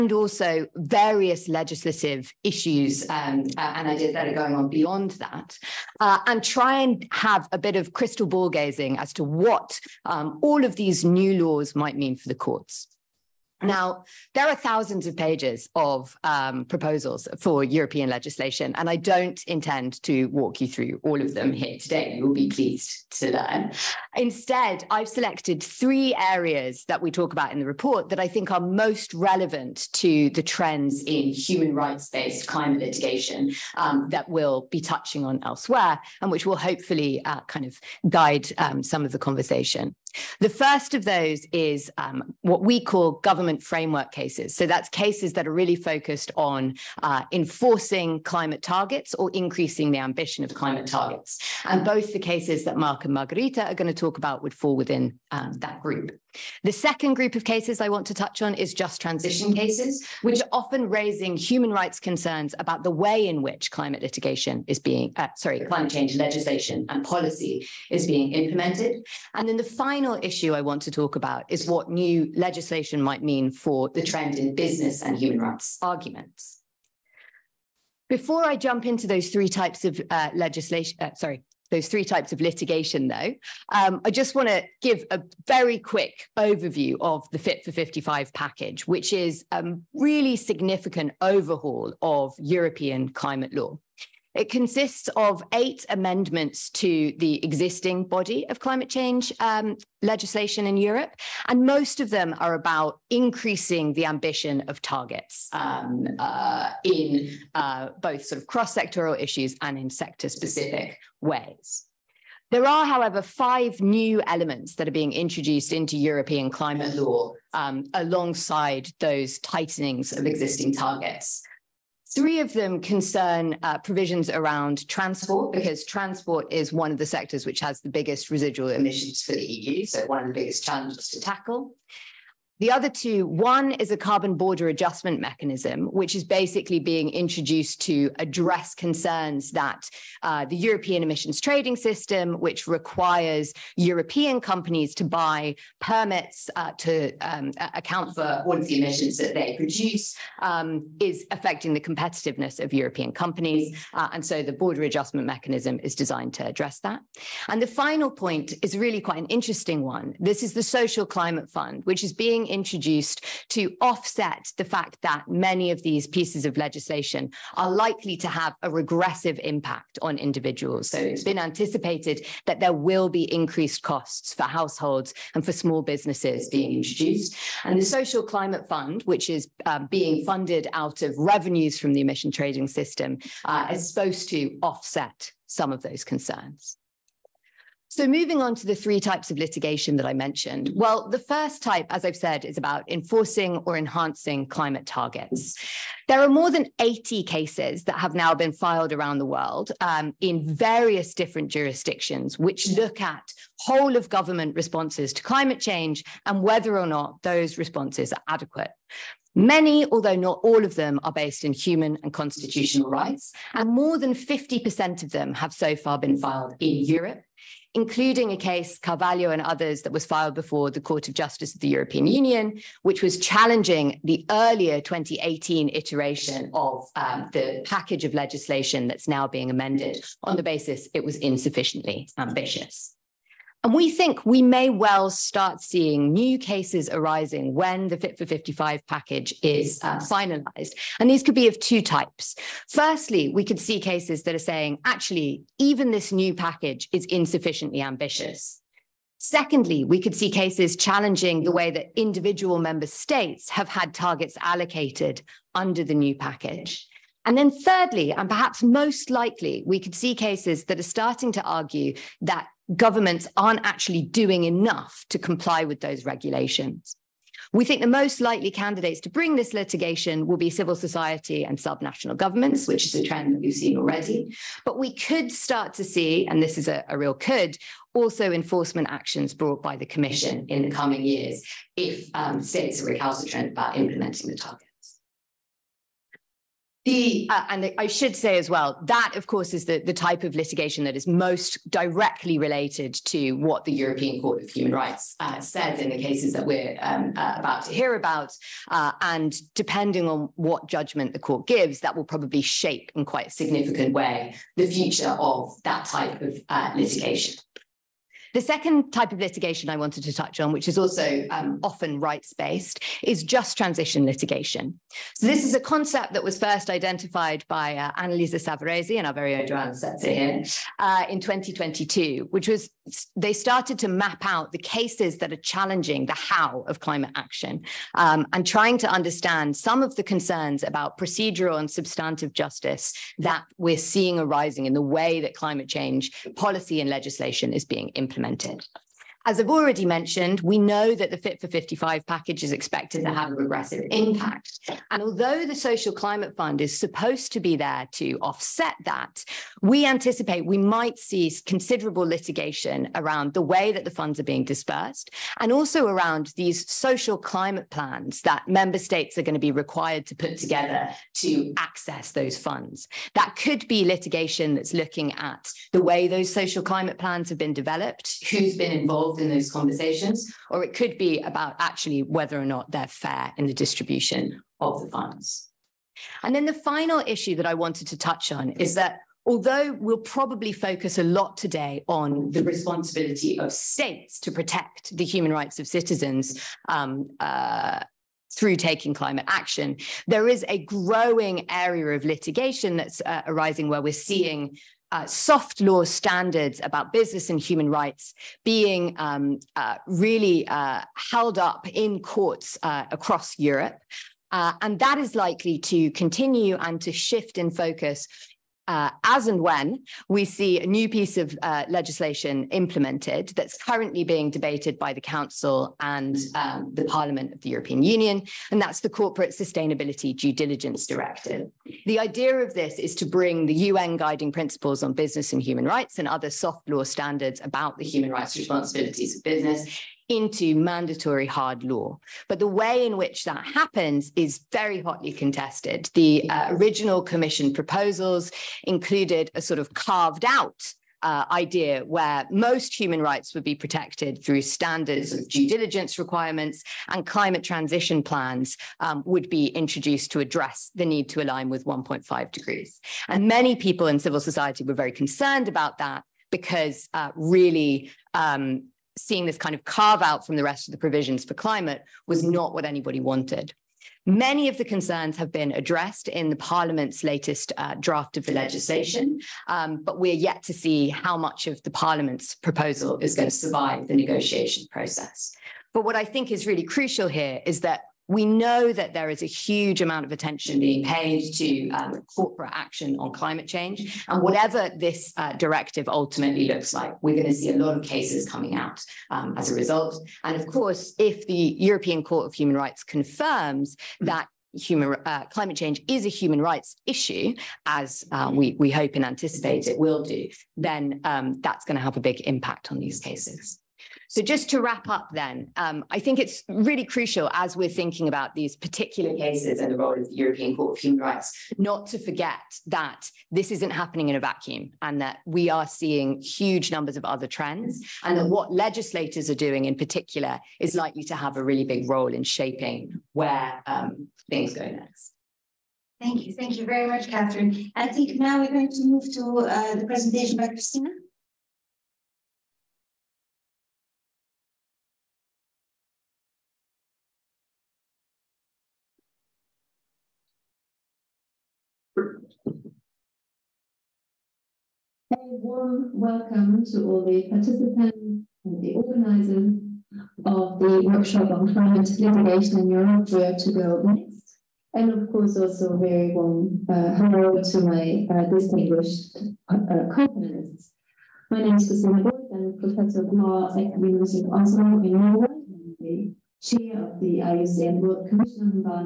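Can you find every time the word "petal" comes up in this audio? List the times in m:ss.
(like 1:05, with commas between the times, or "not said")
not said.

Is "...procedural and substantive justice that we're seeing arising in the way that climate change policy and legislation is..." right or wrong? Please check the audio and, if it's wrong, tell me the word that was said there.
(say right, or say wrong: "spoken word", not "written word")
right.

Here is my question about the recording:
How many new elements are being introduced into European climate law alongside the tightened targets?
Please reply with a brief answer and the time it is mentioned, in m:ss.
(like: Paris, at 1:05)
5, at 1:53.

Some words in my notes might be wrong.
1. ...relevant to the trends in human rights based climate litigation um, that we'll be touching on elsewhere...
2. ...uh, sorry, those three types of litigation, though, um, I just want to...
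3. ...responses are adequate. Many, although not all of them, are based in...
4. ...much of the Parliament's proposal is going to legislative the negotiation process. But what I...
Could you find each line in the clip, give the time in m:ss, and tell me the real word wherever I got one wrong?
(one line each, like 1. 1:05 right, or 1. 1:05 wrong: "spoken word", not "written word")
1. 0:29 right
2. 1:20 right
3. 3:27 right
4. 7:51 wrong: "survive", not "legislative".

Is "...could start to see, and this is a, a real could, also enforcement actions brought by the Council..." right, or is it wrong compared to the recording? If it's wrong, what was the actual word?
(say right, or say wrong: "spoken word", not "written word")
wrong: "Commission", not "Council".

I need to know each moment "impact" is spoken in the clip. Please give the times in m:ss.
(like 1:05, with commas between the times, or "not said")
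2:49, 5:43, 8:22.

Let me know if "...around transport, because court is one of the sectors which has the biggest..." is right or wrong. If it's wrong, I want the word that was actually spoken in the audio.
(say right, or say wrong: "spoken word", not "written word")
wrong: "transport", not "court".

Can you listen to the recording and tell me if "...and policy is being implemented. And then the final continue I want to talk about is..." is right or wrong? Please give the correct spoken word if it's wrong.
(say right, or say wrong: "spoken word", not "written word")
wrong: "issue", not "continue".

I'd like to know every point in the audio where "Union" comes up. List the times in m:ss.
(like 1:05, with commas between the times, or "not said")
3:42, 6:57.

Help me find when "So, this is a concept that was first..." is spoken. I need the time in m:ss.
5:15.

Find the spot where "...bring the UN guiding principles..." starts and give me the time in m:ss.
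7:03.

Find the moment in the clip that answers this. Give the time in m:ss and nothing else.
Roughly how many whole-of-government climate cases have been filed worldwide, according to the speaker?
3:16.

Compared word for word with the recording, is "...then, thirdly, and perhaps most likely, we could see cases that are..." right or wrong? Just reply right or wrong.
right.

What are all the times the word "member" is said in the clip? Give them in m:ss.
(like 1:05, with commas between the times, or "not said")
4:12, 5:58.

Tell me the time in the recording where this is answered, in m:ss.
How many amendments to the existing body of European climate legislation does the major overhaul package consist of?
1:35.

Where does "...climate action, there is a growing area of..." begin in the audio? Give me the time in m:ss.
6:28.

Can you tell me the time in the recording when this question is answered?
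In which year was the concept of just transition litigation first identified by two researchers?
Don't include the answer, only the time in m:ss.
5:21.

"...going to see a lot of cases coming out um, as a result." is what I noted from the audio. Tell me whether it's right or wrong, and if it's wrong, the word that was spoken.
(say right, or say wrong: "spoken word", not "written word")
right.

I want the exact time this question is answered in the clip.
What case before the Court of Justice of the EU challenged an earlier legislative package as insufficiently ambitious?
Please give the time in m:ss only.
3:38.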